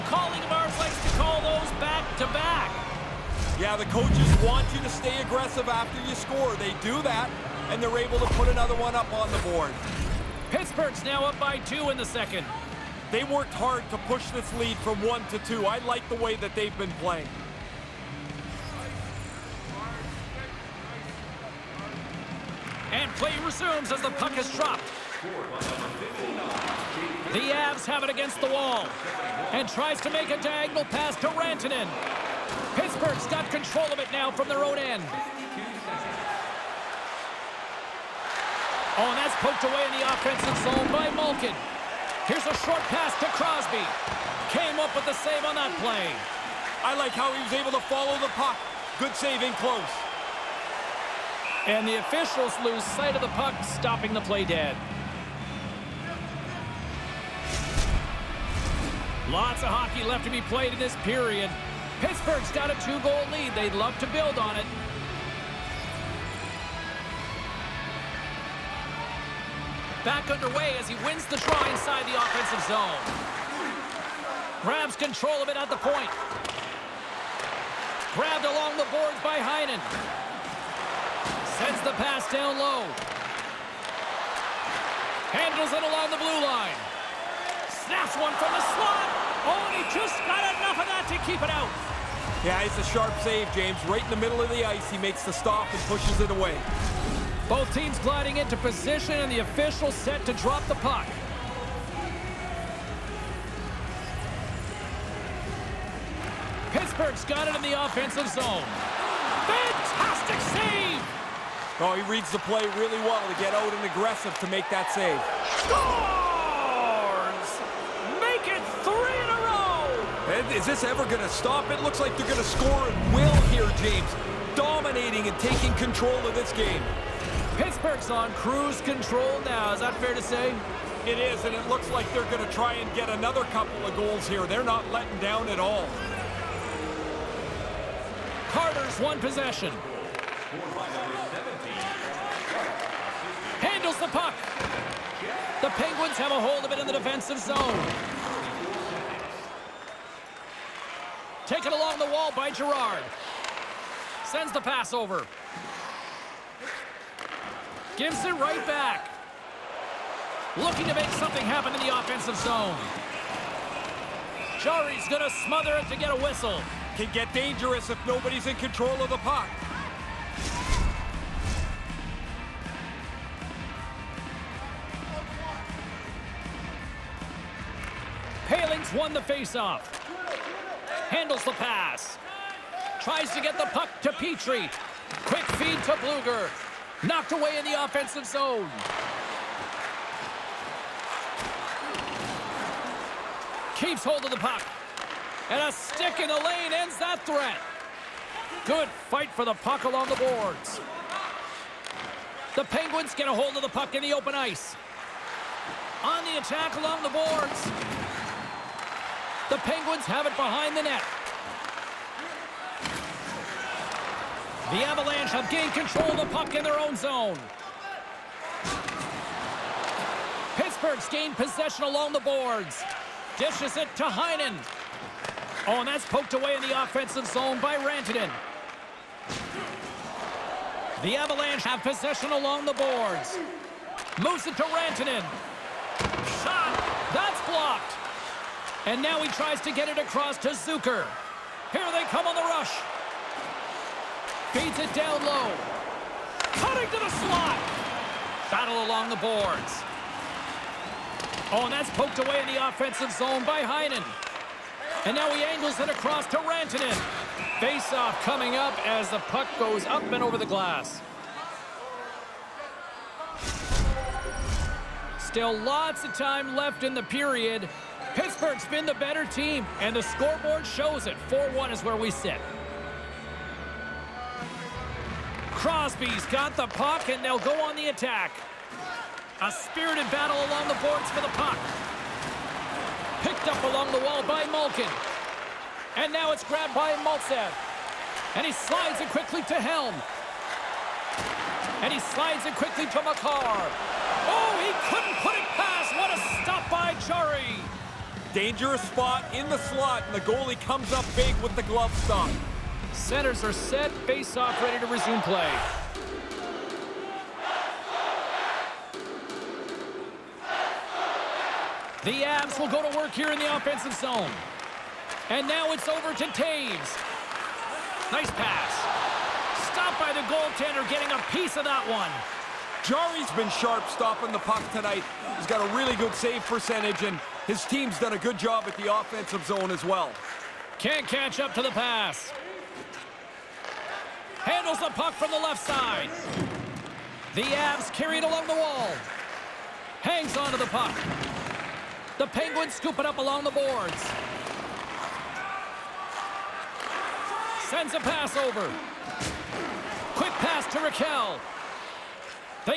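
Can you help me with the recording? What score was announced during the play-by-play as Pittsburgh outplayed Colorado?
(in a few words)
4-1.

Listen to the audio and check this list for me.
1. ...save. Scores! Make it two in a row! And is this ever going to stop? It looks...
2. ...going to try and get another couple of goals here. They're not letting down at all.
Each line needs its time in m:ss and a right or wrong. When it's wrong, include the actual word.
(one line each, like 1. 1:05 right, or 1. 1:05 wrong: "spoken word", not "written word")
1. 1:54 wrong: "three", not "two"
2. 2:12 right.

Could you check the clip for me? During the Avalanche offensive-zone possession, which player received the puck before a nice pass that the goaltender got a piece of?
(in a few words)
Toews.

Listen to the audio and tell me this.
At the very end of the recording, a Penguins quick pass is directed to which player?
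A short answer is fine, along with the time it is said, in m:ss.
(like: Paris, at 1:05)
Rakell, at 5:50.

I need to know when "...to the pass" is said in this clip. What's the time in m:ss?
5:31.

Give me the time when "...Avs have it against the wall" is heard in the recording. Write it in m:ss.
0:27.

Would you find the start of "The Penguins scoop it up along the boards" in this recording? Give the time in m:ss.
5:42.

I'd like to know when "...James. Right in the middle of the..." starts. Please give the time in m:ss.
1:33.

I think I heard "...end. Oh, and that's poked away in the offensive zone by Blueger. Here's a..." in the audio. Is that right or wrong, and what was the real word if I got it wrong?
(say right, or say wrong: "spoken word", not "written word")
wrong: "Malkin", not "Blueger".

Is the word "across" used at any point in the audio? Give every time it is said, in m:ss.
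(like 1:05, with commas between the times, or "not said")
3:59, 4:15.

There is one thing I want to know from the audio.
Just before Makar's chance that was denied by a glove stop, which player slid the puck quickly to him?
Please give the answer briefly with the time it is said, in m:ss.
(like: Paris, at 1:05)
Helm, at 4:49.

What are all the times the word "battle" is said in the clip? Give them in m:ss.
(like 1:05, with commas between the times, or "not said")
4:08, 4:40.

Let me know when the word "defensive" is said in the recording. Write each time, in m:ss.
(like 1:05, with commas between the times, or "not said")
2:26.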